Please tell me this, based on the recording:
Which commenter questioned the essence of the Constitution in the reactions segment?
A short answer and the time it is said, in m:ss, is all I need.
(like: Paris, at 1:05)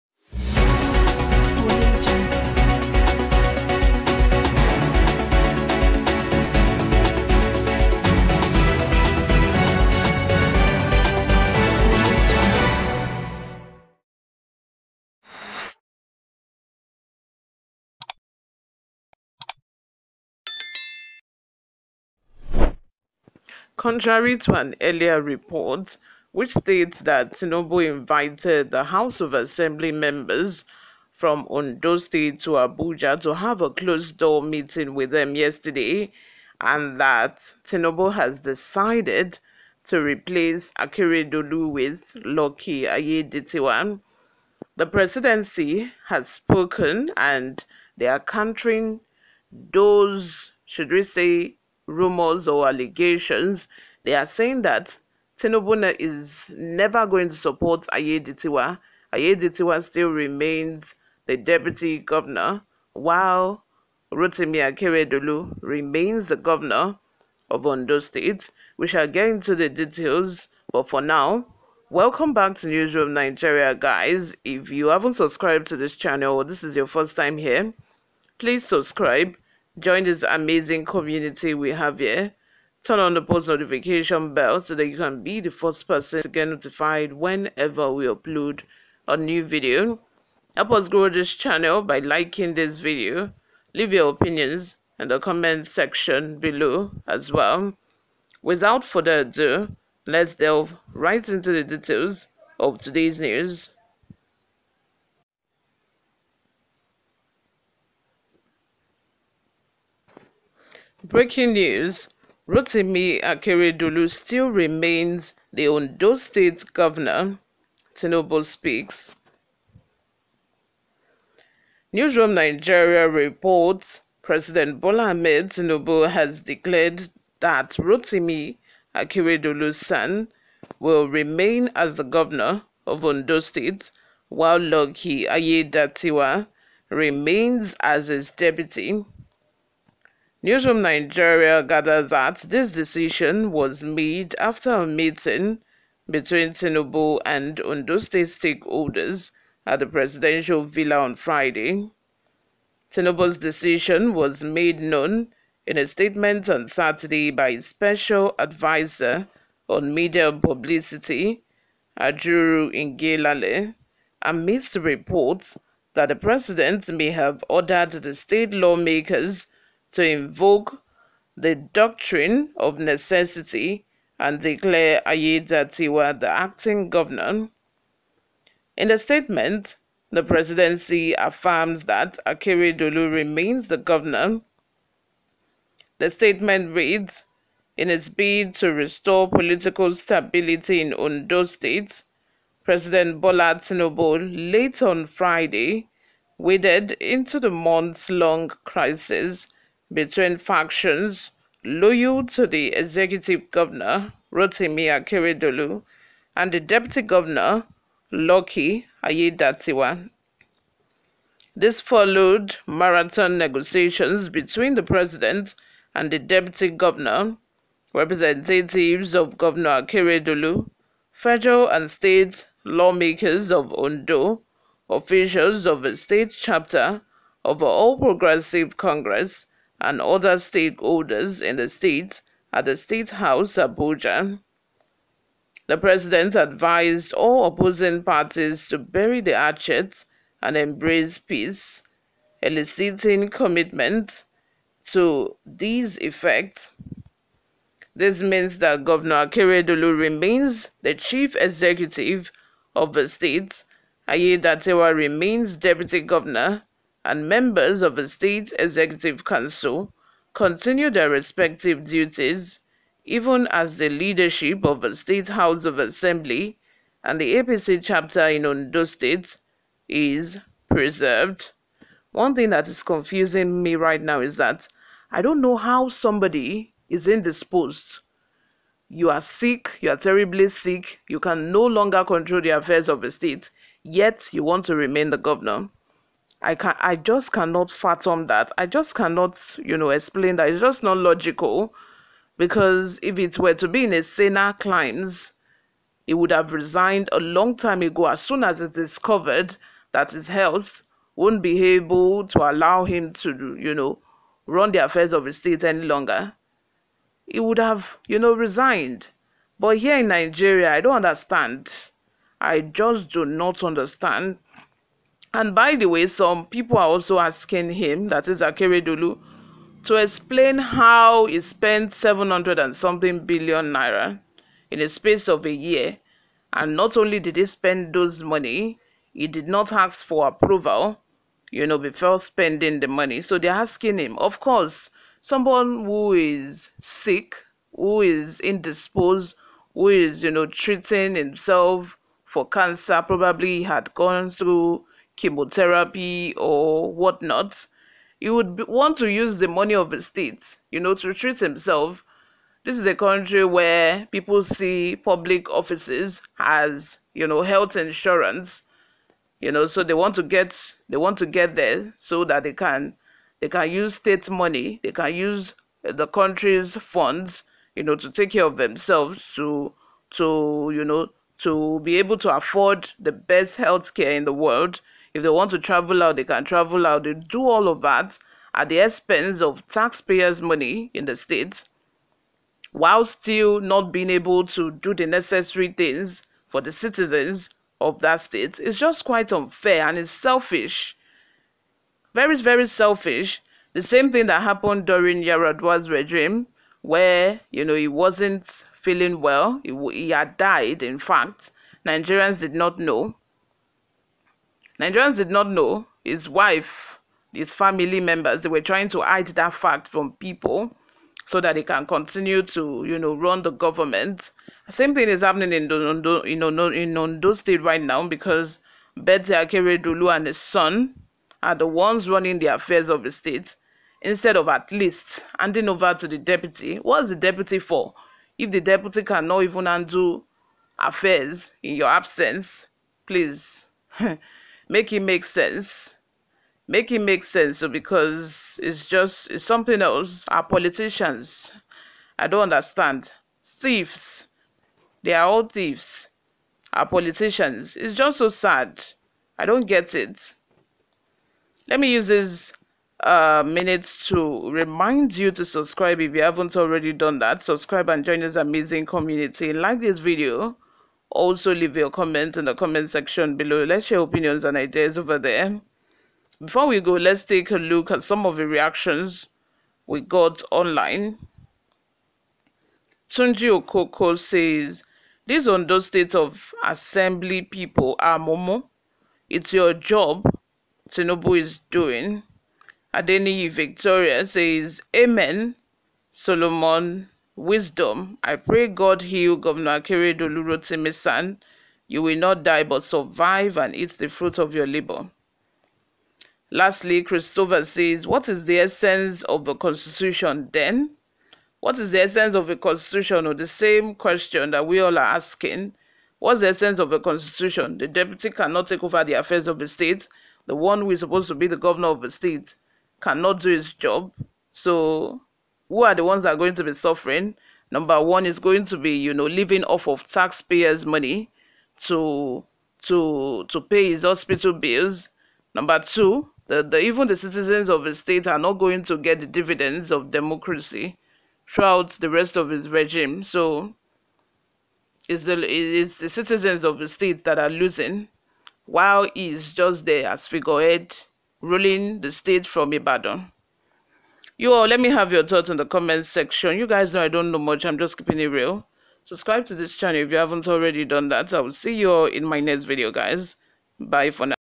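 Christopher, at 8:17.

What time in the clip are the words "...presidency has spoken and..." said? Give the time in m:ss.
0:44.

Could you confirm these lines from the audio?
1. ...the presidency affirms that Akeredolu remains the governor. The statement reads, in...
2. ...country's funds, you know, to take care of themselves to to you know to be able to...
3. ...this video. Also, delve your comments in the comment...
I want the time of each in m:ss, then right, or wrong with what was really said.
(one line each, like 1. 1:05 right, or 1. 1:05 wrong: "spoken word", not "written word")
1. 3:00 right
2. 6:06 right
3. 7:39 wrong: "leave", not "delve".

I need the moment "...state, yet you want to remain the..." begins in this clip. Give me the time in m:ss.
4:43.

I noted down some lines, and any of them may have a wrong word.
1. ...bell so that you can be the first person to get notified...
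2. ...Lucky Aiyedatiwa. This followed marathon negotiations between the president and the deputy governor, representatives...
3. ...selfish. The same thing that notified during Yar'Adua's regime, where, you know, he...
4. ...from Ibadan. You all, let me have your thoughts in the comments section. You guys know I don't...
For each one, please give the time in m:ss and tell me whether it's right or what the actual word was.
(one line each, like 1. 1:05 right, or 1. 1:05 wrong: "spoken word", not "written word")
1. 1:24 right
2. 3:28 right
3. 6:32 wrong: "happened", not "notified"
4. 9:02 right.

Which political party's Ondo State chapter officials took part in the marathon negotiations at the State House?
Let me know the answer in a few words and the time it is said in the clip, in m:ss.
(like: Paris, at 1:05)
All Progressive Congress, at 3:47.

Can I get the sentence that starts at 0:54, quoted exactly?
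They are saying that Tinubu is never going to support Aiyedatiwa.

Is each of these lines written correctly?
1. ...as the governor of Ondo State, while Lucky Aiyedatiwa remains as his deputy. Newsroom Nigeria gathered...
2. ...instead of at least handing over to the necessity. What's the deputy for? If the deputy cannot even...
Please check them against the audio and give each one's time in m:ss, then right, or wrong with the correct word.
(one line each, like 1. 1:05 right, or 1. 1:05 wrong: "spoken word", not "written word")
1. 2:11 right
2. 7:04 wrong: "deputy", not "necessity".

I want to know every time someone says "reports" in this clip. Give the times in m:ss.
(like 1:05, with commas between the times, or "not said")
0:25, 2:03, 2:44.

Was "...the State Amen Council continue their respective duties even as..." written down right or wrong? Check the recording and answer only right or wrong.
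wrong.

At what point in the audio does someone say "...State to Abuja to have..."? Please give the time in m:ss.
0:31.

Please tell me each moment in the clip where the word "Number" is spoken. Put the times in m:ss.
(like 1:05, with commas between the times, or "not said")
8:37, 8:45.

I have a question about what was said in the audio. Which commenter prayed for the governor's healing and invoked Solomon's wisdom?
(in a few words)
Adeniyi Victoria.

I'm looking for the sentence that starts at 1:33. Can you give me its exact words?
Leave your opinions in the comment section below as well.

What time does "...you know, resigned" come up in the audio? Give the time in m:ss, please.
5:08.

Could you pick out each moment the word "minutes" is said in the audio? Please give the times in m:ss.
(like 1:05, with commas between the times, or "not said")
7:33.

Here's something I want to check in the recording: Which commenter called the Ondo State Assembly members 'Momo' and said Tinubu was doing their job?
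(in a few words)
Tunji Okoko.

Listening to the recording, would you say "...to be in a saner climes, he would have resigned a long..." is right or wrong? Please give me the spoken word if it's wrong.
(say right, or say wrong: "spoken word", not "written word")
right.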